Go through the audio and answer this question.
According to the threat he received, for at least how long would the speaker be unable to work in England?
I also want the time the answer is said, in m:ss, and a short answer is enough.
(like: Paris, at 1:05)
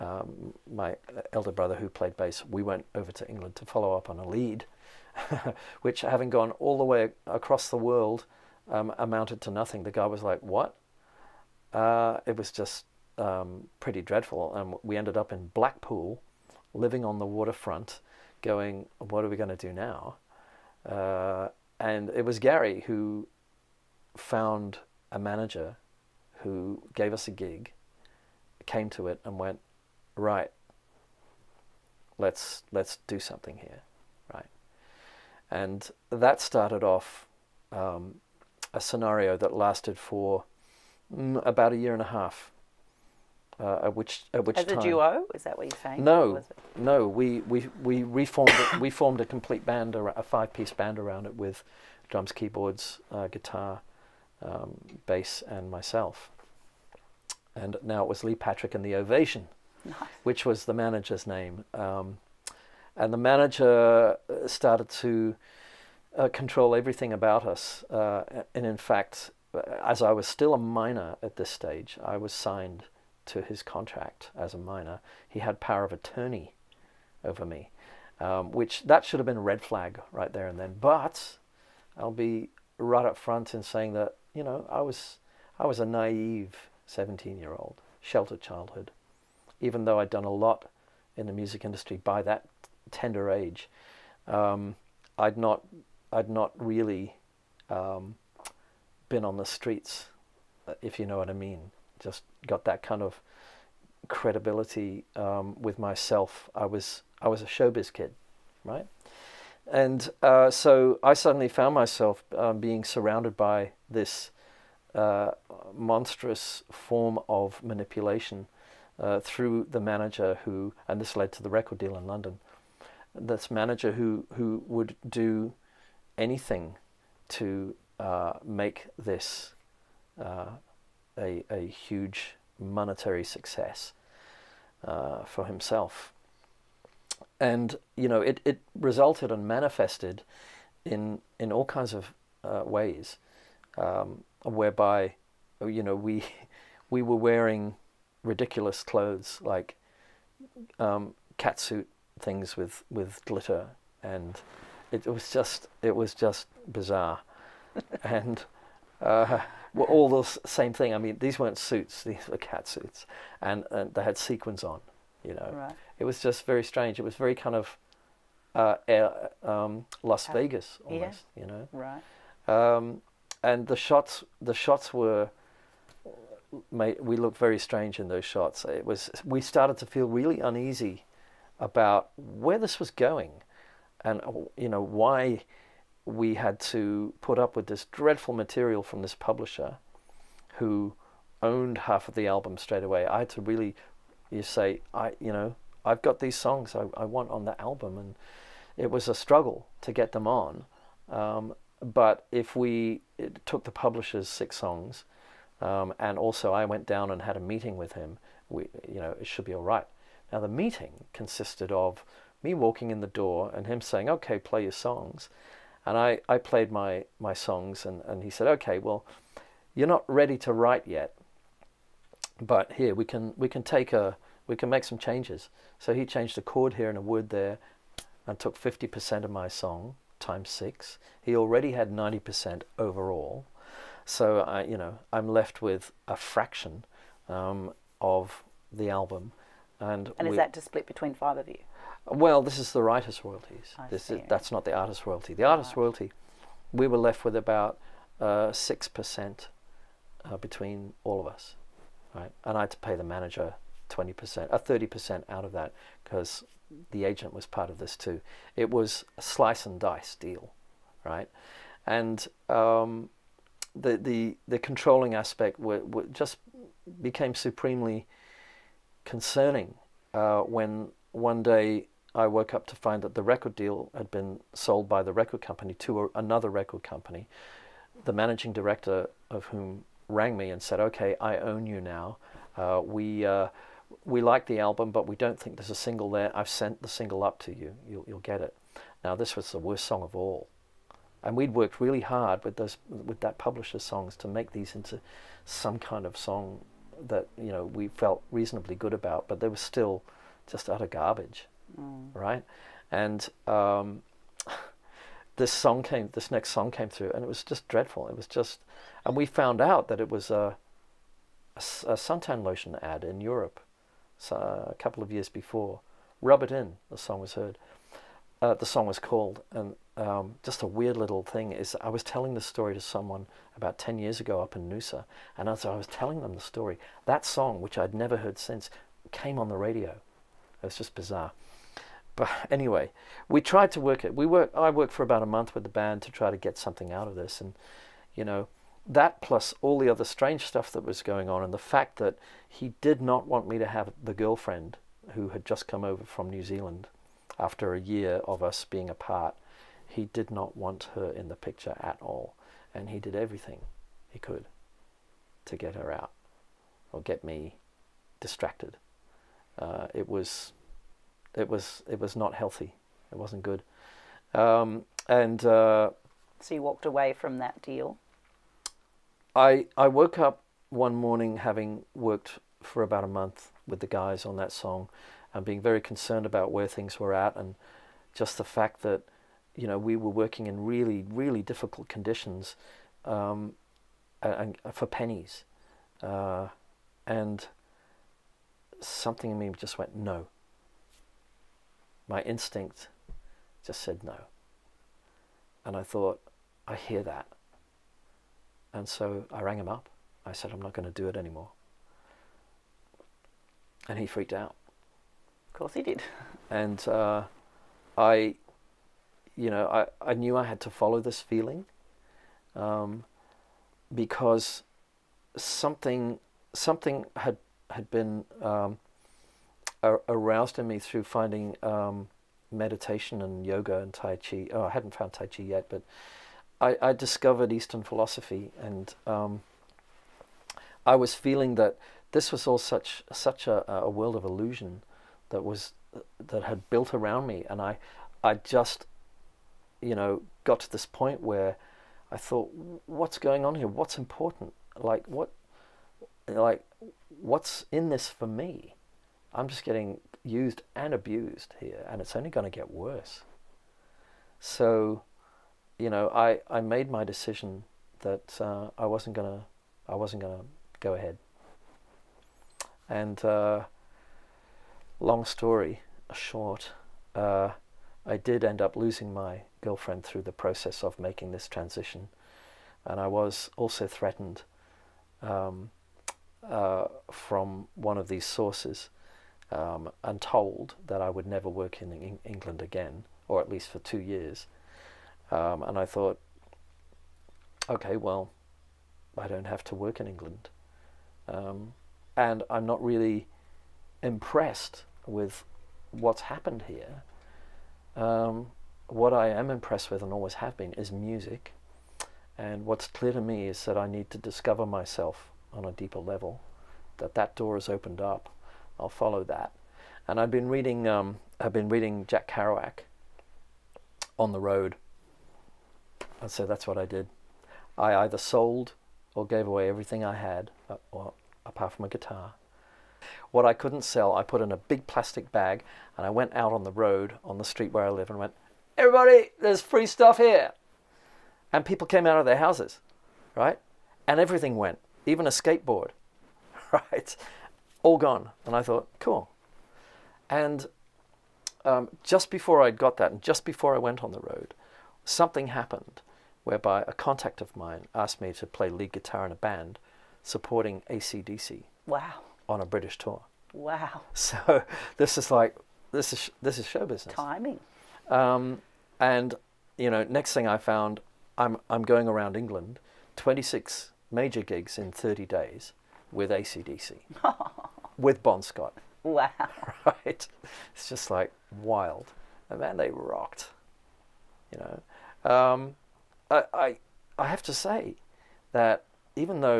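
2 years, at 8:03.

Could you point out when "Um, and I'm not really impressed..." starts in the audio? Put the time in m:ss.
8:11.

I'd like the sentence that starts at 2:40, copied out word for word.
I mean, these weren't suits; these were cat suits, and, and they had sequins on.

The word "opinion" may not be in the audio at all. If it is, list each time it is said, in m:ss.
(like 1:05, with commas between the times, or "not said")
not said.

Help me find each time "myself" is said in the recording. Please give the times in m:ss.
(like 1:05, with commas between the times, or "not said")
0:55, 1:45, 1:51, 8:24.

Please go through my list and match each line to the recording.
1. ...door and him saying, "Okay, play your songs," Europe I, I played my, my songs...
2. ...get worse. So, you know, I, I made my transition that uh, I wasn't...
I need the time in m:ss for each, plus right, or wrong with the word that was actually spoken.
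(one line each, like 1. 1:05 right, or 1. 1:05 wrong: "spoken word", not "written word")
1. 3:33 wrong: "And", not "Europe"
2. 7:32 wrong: "decision", not "transition".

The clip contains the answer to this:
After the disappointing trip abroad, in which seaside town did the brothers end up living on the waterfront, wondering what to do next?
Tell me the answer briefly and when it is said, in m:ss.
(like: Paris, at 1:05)
Blackpool, at 0:15.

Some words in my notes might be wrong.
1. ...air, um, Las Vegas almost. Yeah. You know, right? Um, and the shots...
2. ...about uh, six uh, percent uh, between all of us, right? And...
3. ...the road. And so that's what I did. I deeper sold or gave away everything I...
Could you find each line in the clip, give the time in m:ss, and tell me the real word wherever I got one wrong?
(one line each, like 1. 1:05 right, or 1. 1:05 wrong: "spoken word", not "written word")
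1. 2:48 right
2. 4:07 right
3. 8:34 wrong: "either", not "deeper".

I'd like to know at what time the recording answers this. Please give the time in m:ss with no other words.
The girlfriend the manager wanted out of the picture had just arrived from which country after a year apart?
5:46.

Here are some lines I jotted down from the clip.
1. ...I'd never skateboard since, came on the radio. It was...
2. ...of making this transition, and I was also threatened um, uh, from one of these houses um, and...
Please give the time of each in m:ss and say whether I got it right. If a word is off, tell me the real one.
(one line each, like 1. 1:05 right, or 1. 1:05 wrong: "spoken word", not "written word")
1. 5:27 wrong: "heard", not "skateboard"
2. 7:50 wrong: "sources", not "houses".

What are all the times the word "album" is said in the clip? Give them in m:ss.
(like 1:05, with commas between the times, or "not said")
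3:12, 3:17, 3:58, 4:44.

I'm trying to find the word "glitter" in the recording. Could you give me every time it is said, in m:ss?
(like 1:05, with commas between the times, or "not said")
2:33.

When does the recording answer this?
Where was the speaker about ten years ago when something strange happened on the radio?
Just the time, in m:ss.
5:24.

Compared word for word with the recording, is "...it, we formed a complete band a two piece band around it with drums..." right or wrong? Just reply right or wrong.
wrong.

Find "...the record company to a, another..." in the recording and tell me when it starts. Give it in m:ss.
4:35.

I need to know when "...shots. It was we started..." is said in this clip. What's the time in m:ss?
2:58.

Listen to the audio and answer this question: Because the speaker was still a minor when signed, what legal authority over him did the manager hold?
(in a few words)
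Power of attorney.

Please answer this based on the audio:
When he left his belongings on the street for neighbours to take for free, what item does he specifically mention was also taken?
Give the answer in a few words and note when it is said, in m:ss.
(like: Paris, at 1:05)
Skateboard, at 8:55.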